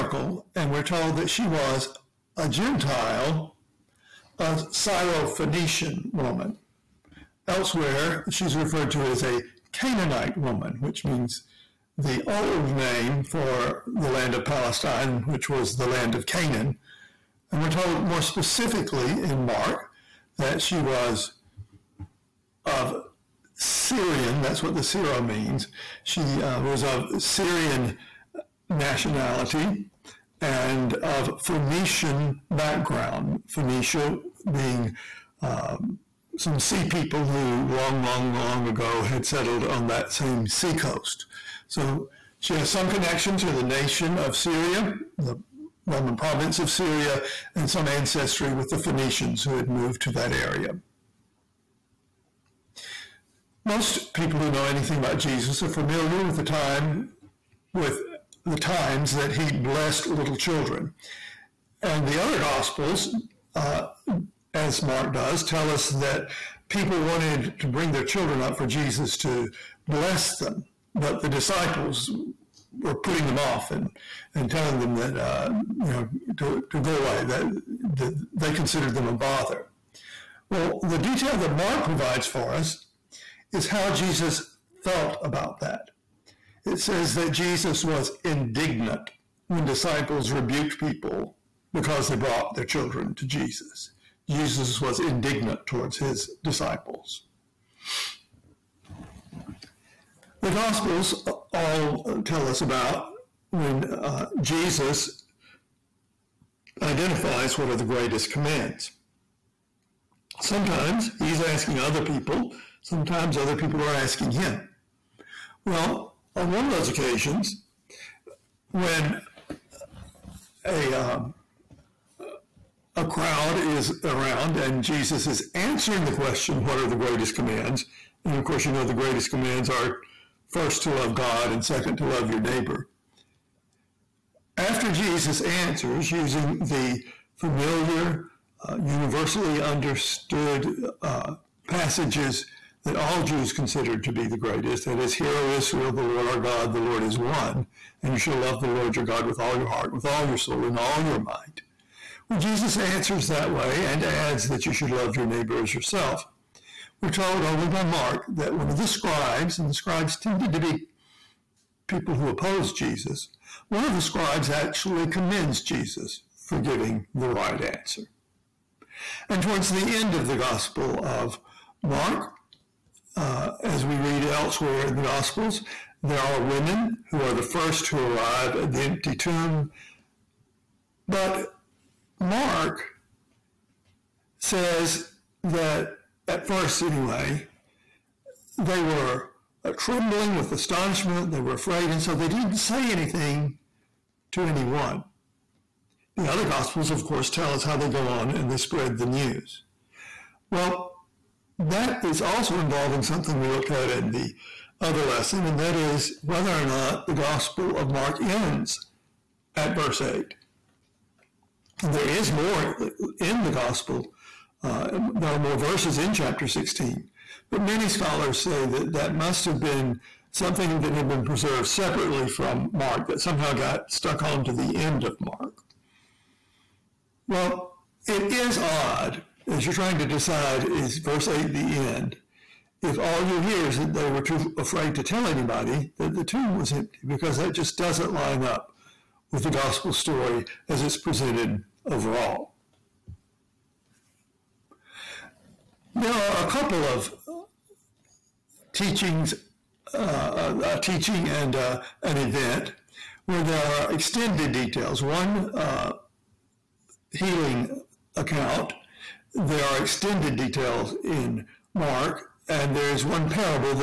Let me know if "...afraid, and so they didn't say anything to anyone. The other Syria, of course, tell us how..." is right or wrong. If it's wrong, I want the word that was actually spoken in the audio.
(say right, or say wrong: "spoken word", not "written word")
wrong: "Gospels", not "Syria".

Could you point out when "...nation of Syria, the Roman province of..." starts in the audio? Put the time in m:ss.
0:43.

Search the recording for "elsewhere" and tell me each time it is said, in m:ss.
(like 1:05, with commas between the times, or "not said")
0:07, 2:54.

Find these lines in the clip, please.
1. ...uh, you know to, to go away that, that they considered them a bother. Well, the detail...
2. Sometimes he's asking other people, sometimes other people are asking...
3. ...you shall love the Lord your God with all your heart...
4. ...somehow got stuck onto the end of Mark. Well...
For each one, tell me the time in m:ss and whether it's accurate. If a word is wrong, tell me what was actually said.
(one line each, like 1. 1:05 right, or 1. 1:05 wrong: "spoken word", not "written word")
1. 1:15 right
2. 1:50 right
3. 2:28 right
4. 3:43 right.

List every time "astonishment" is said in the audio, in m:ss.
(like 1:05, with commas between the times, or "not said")
3:10.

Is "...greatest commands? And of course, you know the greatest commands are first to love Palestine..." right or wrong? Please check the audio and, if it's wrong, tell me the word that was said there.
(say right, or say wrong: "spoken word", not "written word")
wrong: "God", not "Palestine".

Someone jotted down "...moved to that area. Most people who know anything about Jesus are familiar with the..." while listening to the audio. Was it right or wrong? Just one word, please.
right.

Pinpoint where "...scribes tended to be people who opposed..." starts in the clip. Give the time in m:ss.
2:39.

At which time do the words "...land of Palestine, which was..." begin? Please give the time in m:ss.
0:14.